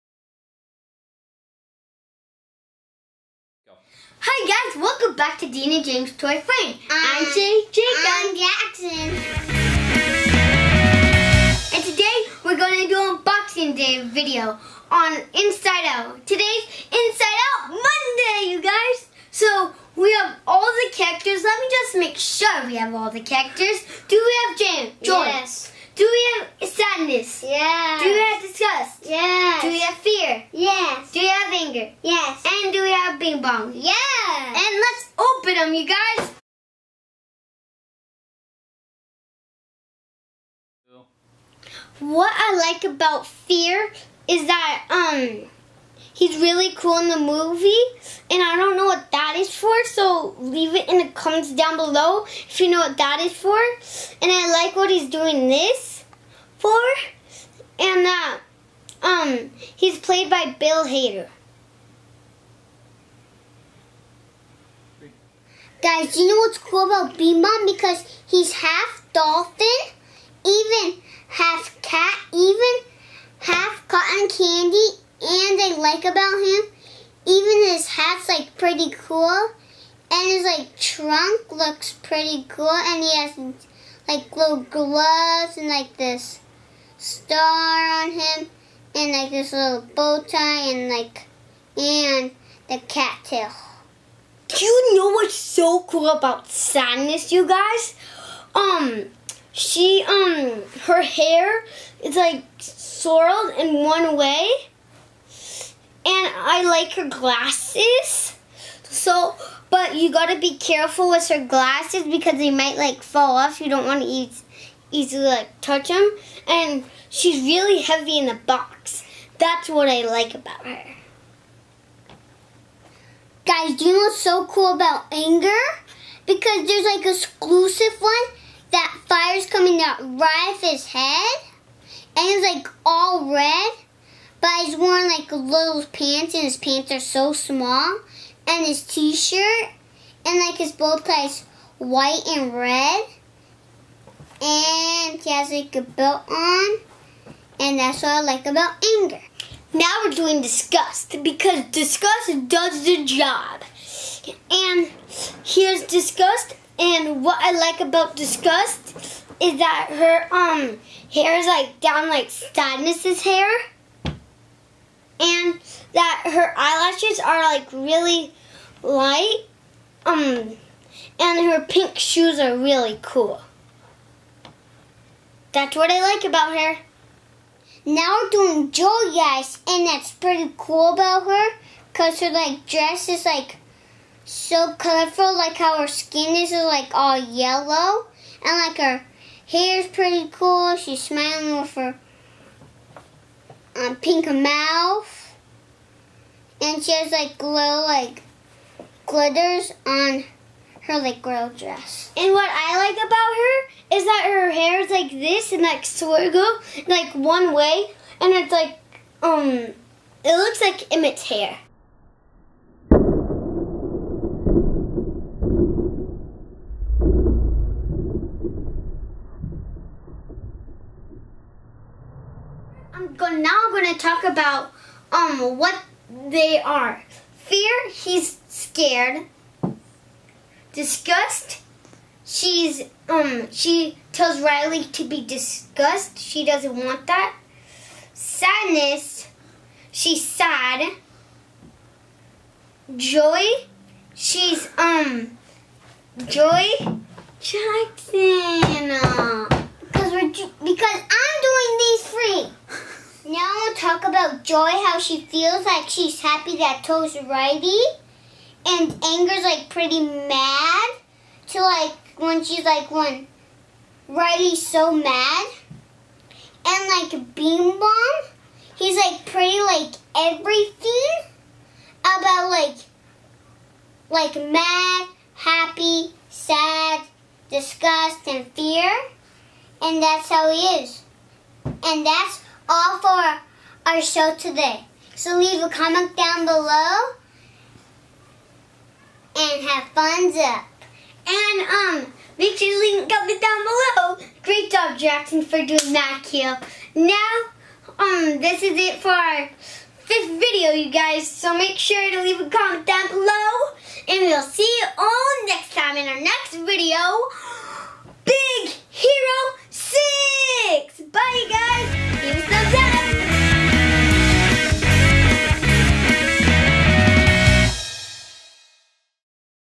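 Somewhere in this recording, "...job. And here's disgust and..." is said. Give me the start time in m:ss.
2:33.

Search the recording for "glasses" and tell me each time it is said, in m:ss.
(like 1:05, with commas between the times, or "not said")
1:47, 1:51.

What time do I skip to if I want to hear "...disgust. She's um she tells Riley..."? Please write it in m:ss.
3:50.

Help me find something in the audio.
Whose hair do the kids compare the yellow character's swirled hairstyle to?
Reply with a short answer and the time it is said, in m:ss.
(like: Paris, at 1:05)
Emmett, at 3:30.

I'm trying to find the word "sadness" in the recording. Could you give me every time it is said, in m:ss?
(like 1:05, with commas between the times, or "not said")
0:26, 1:36, 2:42, 3:58.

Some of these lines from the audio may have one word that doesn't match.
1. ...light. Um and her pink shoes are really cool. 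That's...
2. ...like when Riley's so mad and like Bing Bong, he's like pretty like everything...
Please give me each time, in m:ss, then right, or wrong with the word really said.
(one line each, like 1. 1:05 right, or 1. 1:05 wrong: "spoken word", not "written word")
1. 2:48 right
2. 4:22 right.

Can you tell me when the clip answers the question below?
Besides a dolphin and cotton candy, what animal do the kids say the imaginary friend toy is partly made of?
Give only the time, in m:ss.
1:10.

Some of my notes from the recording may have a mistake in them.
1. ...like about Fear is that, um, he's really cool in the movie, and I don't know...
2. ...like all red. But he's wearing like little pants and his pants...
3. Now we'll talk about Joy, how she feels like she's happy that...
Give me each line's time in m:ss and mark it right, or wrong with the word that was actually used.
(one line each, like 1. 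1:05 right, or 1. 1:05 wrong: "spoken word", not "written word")
1. 0:42 right
2. 2:12 right
3. 4:13 right.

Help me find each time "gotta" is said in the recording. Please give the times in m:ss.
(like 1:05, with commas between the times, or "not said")
1:50.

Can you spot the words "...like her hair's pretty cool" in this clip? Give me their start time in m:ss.
3:08.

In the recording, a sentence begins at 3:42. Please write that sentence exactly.
I'm go now I'm gonna talk about um what they are.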